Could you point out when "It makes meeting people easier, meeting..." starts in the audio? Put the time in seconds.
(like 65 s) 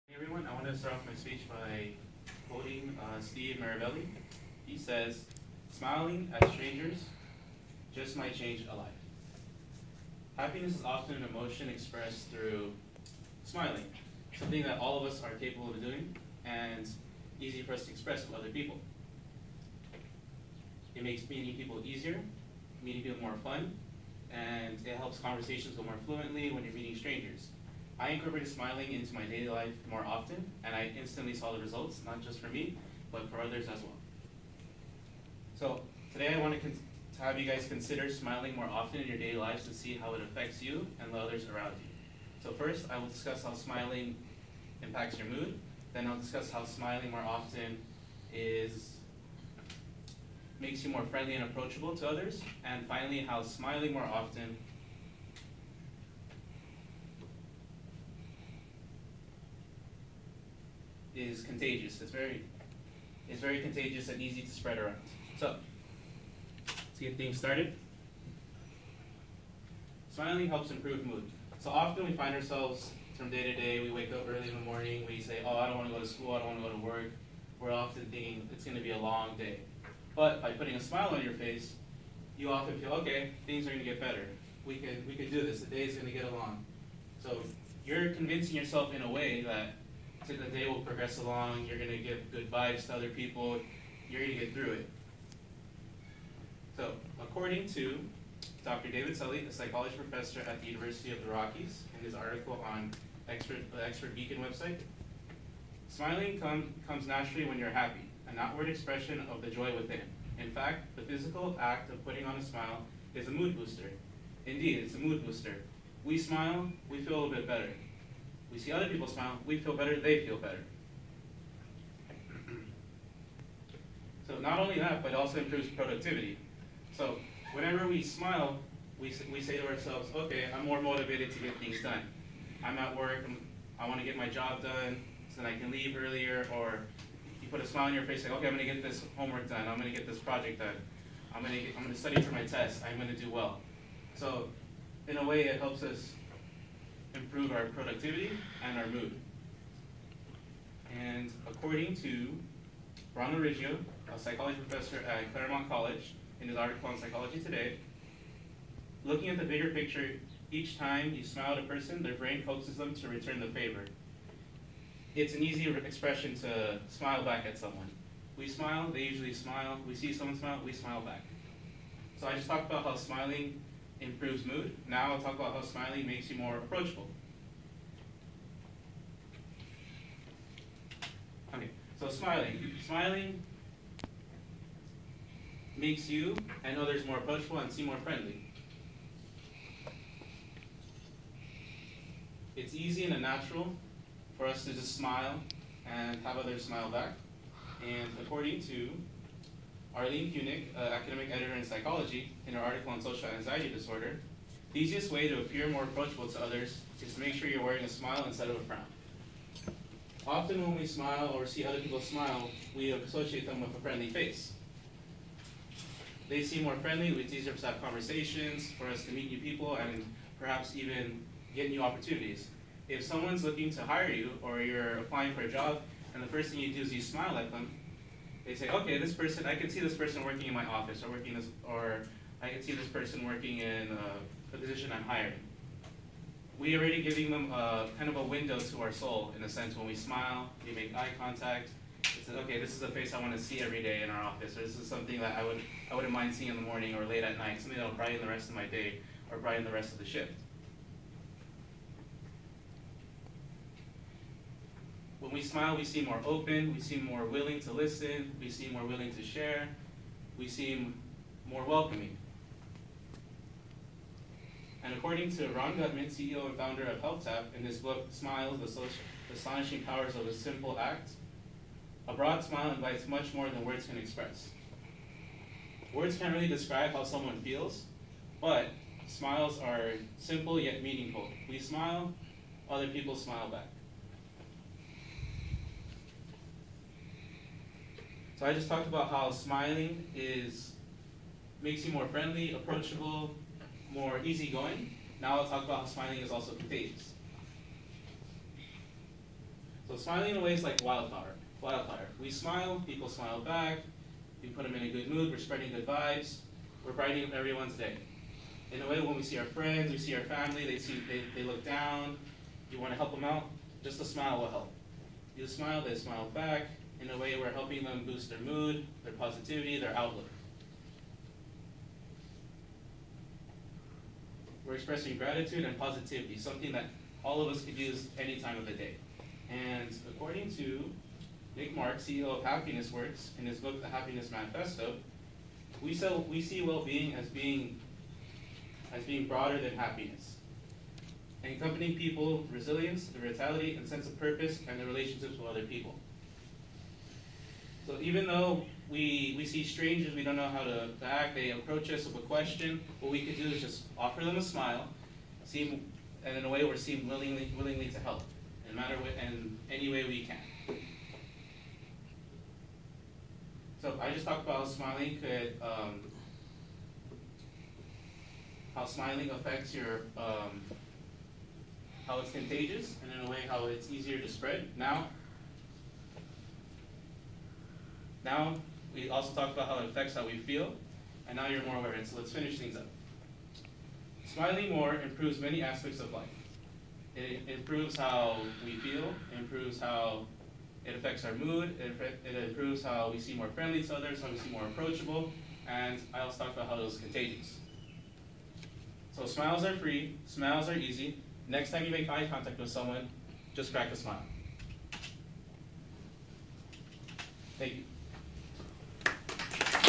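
20 s.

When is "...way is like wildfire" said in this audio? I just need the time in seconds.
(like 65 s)
300 s.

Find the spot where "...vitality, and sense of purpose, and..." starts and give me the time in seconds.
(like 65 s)
343 s.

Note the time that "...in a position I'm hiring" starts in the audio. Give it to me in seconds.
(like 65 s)
233 s.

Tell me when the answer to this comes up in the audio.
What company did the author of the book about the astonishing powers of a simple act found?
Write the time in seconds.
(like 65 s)
267 s.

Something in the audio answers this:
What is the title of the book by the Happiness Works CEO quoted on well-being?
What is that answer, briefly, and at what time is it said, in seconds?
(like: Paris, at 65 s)
The Happiness Manifesto, at 333 s.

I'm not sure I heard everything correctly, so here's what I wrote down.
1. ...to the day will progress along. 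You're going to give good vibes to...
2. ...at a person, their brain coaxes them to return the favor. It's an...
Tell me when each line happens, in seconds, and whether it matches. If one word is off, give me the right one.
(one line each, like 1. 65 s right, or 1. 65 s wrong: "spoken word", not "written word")
1. 90 s right
2. 161 s right.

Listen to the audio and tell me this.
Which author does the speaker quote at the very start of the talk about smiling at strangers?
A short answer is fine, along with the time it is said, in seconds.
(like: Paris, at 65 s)
Steve Maraboli, at 3 s.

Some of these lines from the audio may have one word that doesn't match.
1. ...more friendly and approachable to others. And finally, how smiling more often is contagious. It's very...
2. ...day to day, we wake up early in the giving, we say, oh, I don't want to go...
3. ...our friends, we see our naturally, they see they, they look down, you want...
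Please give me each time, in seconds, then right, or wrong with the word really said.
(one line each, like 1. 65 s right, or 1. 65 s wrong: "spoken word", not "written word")
1. 50 s right
2. 73 s wrong: "morning", not "giving"
3. 309 s wrong: "family", not "naturally".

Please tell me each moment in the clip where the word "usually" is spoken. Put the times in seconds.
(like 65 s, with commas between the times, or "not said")
169 s.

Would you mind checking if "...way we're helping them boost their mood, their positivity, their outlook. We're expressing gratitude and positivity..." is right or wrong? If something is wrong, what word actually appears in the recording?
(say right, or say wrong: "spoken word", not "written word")
right.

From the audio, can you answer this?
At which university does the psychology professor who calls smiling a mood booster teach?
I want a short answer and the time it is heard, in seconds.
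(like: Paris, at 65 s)
University of the Rockies, at 100 s.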